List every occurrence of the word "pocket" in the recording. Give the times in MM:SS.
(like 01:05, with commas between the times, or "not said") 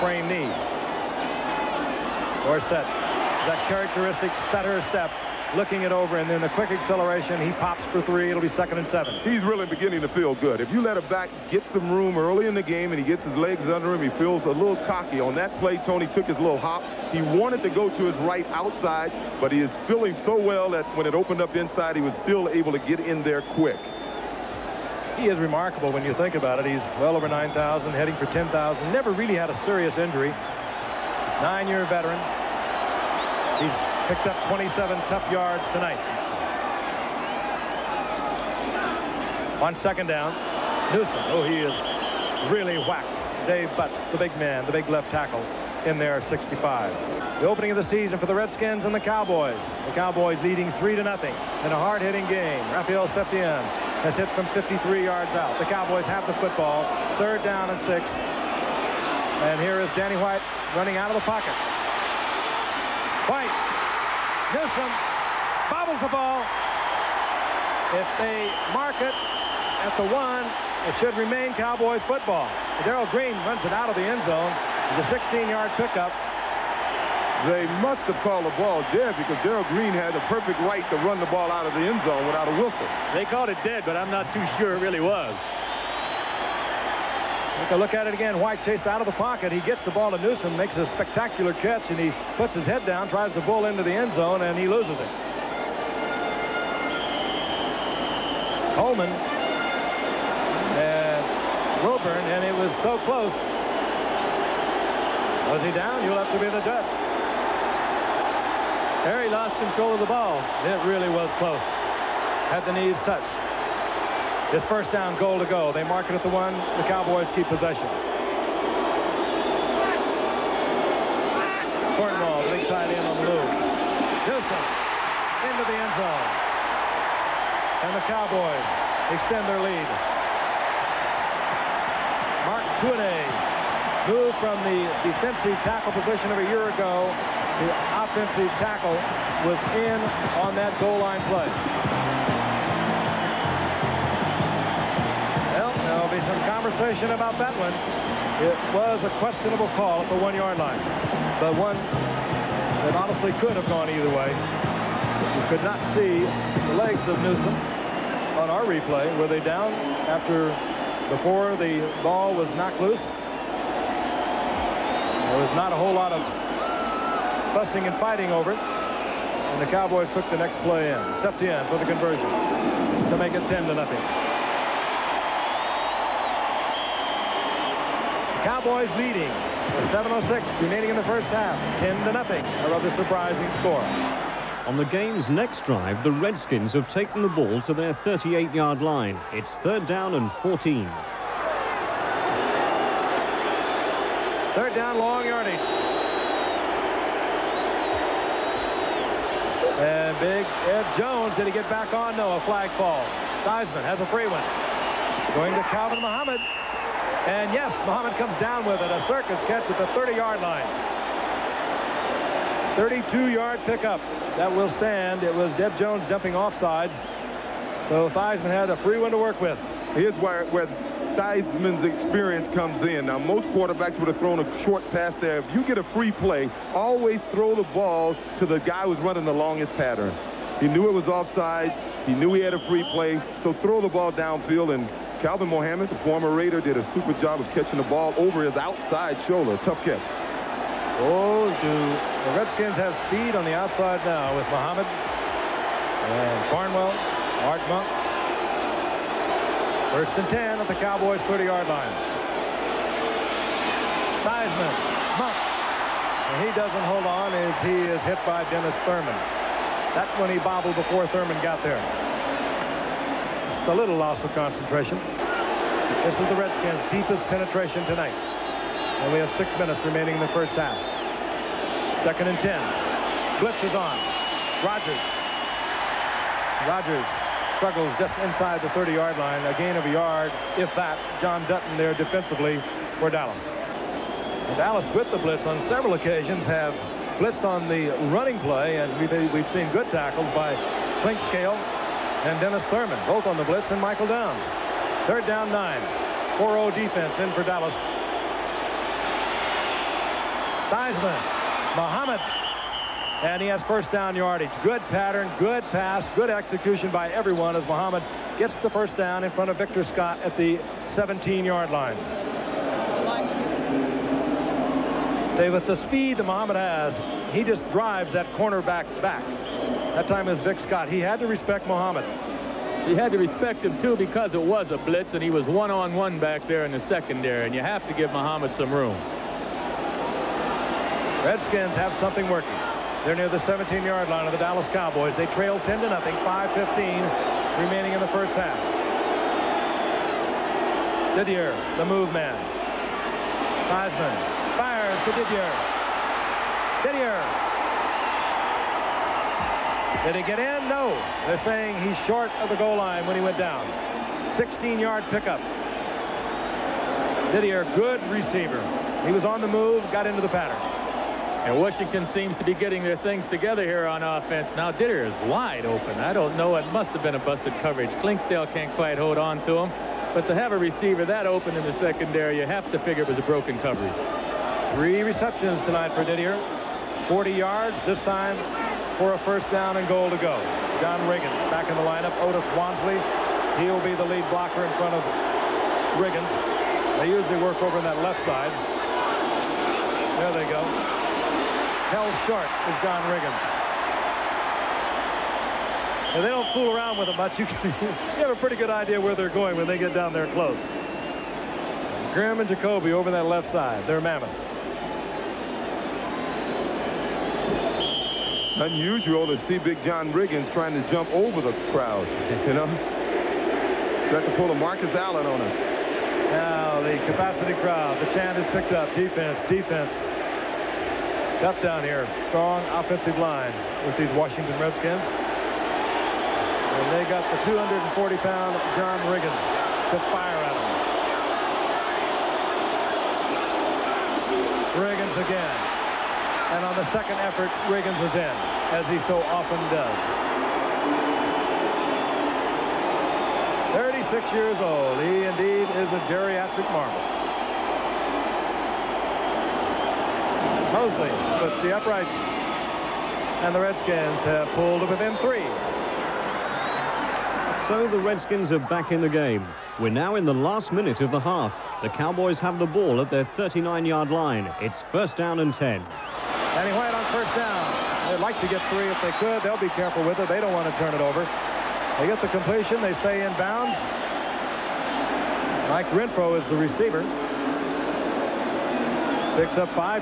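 01:01, 01:29.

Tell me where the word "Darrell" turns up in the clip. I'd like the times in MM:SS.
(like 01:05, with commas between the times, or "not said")
01:12, 01:19.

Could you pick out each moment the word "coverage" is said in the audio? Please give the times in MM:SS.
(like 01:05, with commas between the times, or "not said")
06:07, 06:13.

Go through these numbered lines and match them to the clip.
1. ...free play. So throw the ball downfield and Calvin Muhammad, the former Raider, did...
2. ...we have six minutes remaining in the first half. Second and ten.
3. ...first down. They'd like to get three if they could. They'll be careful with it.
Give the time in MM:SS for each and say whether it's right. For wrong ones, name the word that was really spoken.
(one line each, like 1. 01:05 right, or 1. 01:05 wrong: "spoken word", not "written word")
1. 03:52 right
2. 04:29 right
3. 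07:47 right.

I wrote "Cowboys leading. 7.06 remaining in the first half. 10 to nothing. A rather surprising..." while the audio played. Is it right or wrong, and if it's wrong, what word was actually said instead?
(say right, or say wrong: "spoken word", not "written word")
right.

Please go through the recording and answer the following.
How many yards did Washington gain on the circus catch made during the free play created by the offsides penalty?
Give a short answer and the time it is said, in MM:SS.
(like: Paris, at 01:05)
32, at 03:32.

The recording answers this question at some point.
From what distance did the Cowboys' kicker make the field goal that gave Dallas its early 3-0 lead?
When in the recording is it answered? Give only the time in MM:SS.
00:54.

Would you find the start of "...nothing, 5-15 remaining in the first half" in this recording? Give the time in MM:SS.
05:35.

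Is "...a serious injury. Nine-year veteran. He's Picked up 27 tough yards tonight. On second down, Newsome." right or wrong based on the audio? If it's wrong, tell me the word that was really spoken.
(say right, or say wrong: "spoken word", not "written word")
right.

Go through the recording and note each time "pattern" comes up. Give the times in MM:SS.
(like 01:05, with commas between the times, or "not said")
03:49, 05:04, 06:00.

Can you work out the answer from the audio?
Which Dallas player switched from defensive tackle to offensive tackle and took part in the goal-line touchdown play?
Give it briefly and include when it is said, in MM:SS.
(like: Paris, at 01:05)
Mark Tuinei, at 02:12.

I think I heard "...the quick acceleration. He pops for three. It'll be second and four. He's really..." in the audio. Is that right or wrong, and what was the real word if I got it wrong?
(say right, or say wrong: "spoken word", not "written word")
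wrong: "seven", not "four".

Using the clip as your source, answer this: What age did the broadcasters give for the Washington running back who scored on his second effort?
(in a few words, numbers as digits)
36.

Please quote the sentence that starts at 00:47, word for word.
The opening of the season for the Redskins and the Cowboys.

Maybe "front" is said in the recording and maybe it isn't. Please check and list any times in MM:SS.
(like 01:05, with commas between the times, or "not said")
05:09, 06:24.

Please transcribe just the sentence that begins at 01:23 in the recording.
They called it dead, but I'm not too sure it really was.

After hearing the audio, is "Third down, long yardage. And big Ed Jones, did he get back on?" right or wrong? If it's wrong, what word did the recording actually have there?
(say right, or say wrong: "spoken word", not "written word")
right.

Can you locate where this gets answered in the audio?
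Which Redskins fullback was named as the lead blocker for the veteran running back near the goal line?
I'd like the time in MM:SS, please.
06:22.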